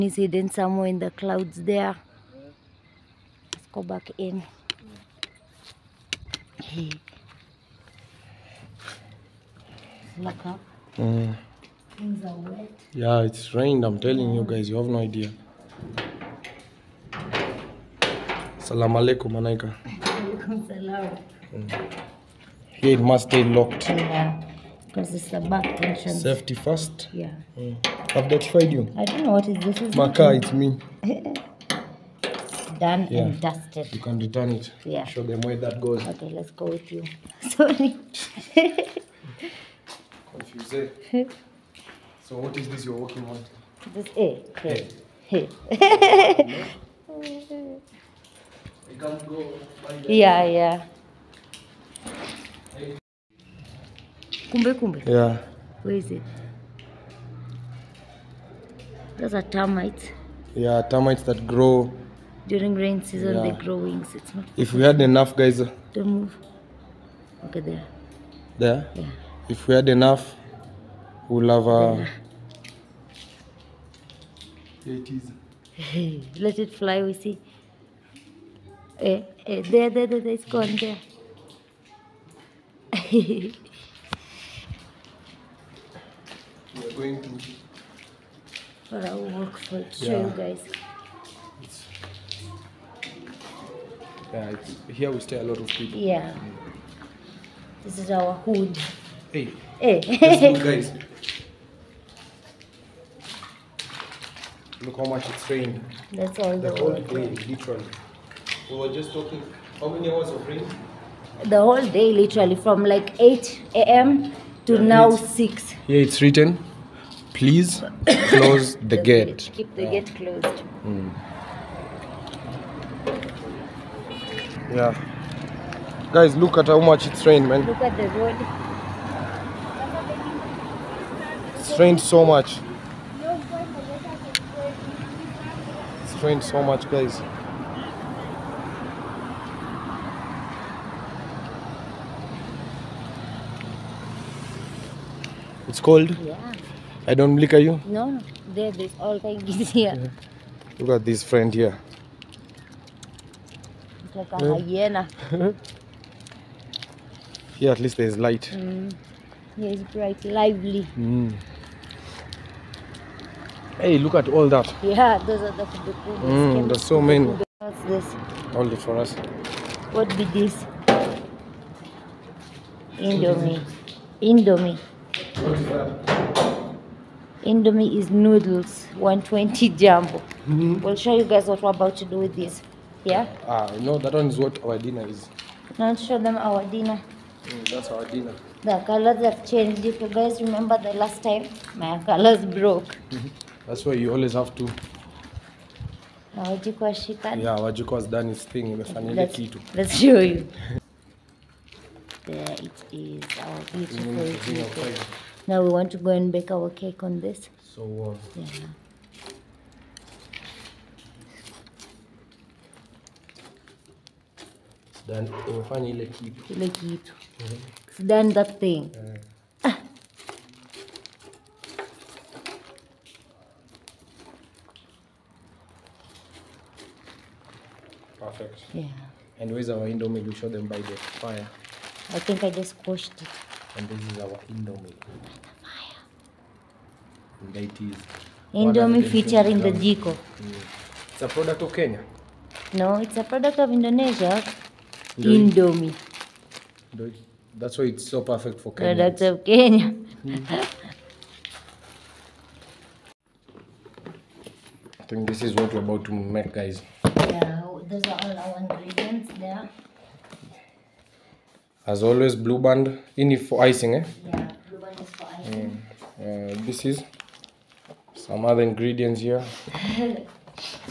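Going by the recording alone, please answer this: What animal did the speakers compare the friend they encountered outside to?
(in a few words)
Hyena.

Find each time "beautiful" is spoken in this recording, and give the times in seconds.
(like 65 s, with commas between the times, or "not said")
203 s.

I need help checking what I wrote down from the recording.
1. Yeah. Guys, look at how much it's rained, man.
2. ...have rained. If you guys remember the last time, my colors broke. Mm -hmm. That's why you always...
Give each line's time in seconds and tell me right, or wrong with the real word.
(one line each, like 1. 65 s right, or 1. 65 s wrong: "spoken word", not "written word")
1. 124 s right
2. 189 s wrong: "changed", not "rained".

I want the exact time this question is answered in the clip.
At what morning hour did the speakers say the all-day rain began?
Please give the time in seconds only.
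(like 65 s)
113 s.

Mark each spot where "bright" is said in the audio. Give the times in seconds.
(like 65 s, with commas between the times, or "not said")
159 s.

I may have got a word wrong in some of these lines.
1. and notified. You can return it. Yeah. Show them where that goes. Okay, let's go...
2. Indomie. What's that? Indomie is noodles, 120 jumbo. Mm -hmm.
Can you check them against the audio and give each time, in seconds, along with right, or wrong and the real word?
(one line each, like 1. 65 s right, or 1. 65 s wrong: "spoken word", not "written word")
1. 33 s wrong: "dusted", not "notified"
2. 174 s right.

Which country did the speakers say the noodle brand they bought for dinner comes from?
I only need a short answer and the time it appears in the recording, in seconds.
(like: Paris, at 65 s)
Indonesia, at 243 s.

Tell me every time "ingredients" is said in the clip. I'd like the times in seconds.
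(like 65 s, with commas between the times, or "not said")
258 s, 268 s.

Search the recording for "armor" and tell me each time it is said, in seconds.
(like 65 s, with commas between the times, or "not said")
not said.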